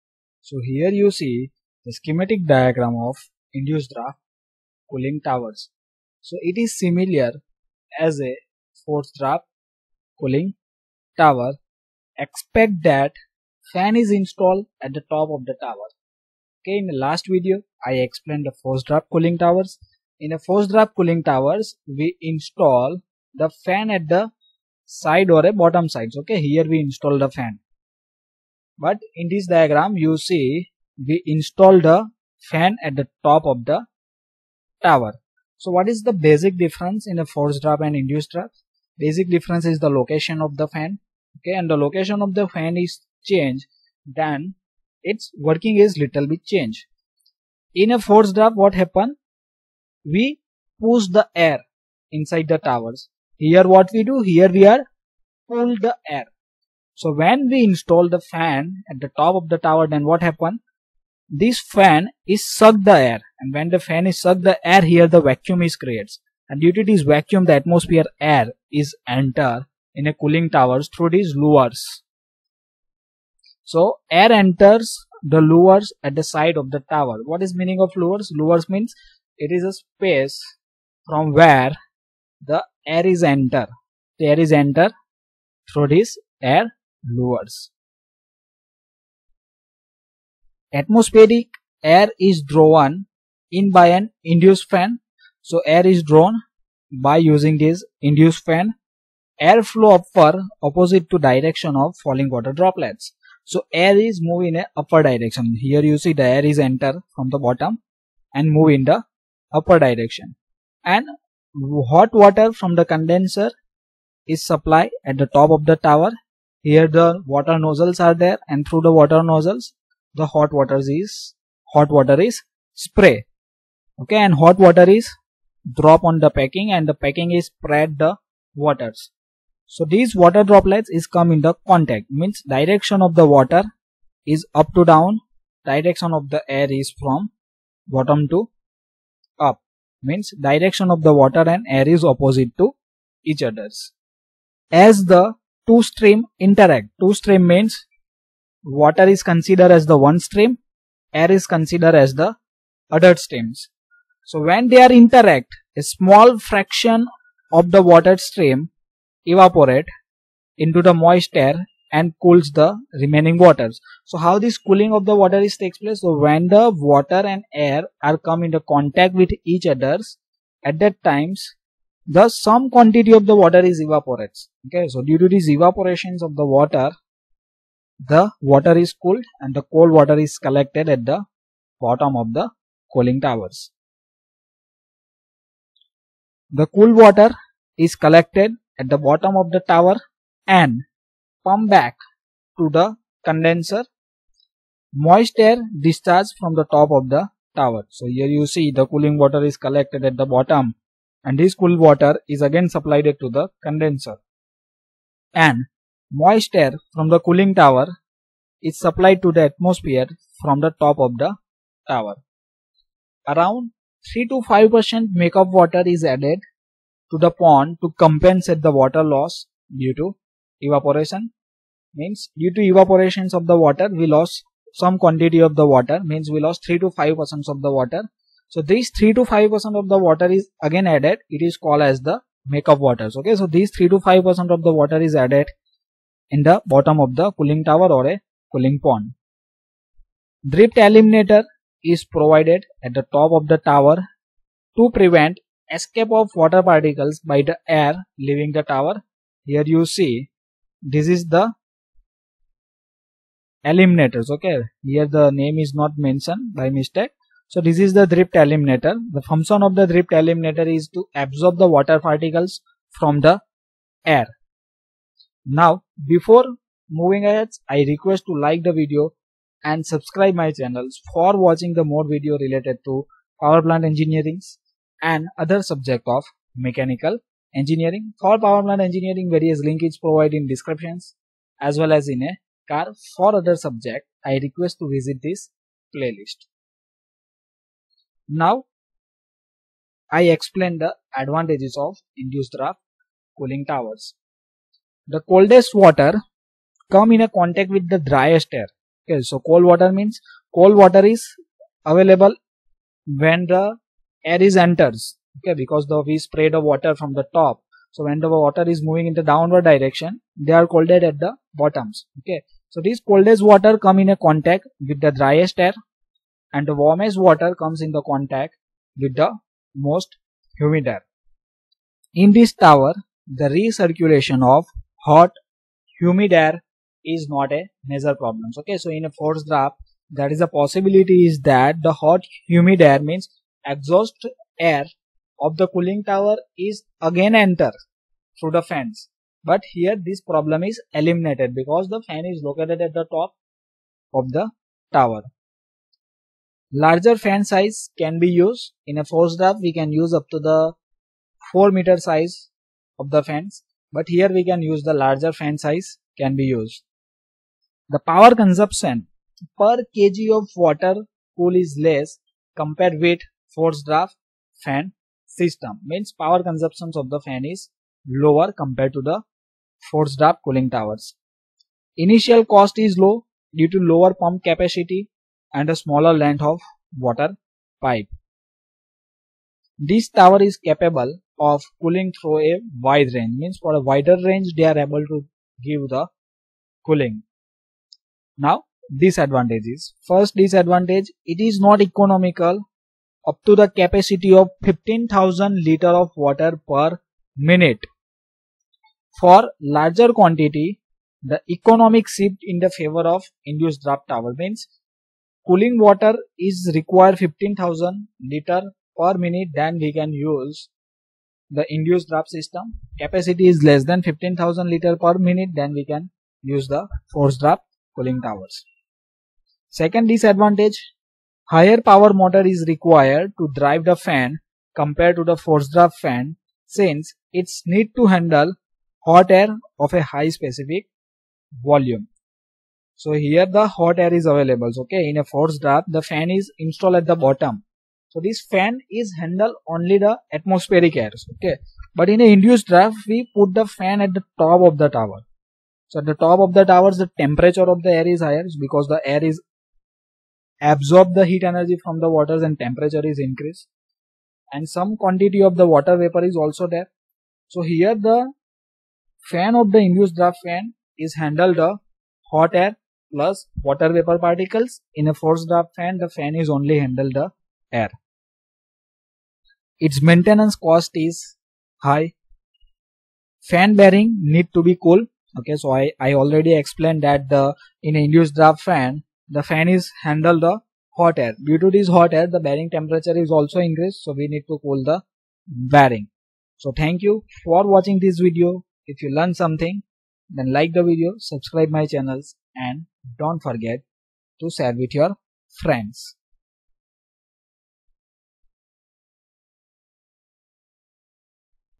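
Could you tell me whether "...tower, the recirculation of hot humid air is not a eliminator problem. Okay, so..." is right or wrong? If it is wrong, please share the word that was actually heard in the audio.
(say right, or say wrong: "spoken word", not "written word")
wrong: "major", not "eliminator".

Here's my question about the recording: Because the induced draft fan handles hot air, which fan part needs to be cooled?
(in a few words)
Fan bearing.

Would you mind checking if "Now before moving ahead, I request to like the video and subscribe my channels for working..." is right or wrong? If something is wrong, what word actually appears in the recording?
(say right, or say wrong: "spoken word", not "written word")
wrong: "watching", not "working".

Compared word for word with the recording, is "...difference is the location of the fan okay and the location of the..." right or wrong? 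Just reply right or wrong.
right.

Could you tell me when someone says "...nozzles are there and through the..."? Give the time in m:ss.
1:57.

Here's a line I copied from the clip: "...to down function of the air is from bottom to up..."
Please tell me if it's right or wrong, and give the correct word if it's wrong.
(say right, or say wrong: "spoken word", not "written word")
wrong: "direction", not "function".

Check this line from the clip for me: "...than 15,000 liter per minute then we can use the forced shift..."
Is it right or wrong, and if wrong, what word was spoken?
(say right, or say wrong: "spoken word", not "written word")
wrong: "draft", not "shift".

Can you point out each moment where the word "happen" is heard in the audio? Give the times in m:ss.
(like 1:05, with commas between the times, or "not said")
0:48, 1:00.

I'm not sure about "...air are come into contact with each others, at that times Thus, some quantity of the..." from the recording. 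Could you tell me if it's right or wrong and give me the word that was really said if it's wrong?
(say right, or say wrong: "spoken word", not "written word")
right.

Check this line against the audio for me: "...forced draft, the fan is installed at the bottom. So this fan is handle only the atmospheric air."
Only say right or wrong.
right.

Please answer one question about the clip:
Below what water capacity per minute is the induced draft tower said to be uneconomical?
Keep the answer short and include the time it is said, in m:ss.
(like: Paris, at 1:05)
15,000 liters per minute, at 6:34.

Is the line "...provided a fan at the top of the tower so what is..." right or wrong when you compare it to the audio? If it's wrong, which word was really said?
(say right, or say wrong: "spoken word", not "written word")
wrong: "installed", not "provided".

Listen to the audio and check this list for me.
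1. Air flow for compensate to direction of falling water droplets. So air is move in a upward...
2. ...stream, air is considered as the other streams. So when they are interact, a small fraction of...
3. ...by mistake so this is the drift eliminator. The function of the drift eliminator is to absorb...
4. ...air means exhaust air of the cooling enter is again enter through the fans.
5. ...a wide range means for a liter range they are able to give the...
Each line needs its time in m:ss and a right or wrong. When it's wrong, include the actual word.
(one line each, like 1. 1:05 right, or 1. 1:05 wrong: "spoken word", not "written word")
1. 1:39 wrong: "opposite", not "compensate"
2. 2:30 right
3. 4:16 right
4. 5:32 wrong: "tower", not "enter"
5. 6:22 wrong: "wider", not "liter".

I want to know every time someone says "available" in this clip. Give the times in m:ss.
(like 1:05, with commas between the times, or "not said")
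5:01, 7:14.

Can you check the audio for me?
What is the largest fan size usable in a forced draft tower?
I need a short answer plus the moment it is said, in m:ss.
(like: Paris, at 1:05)
4 meters, at 5:51.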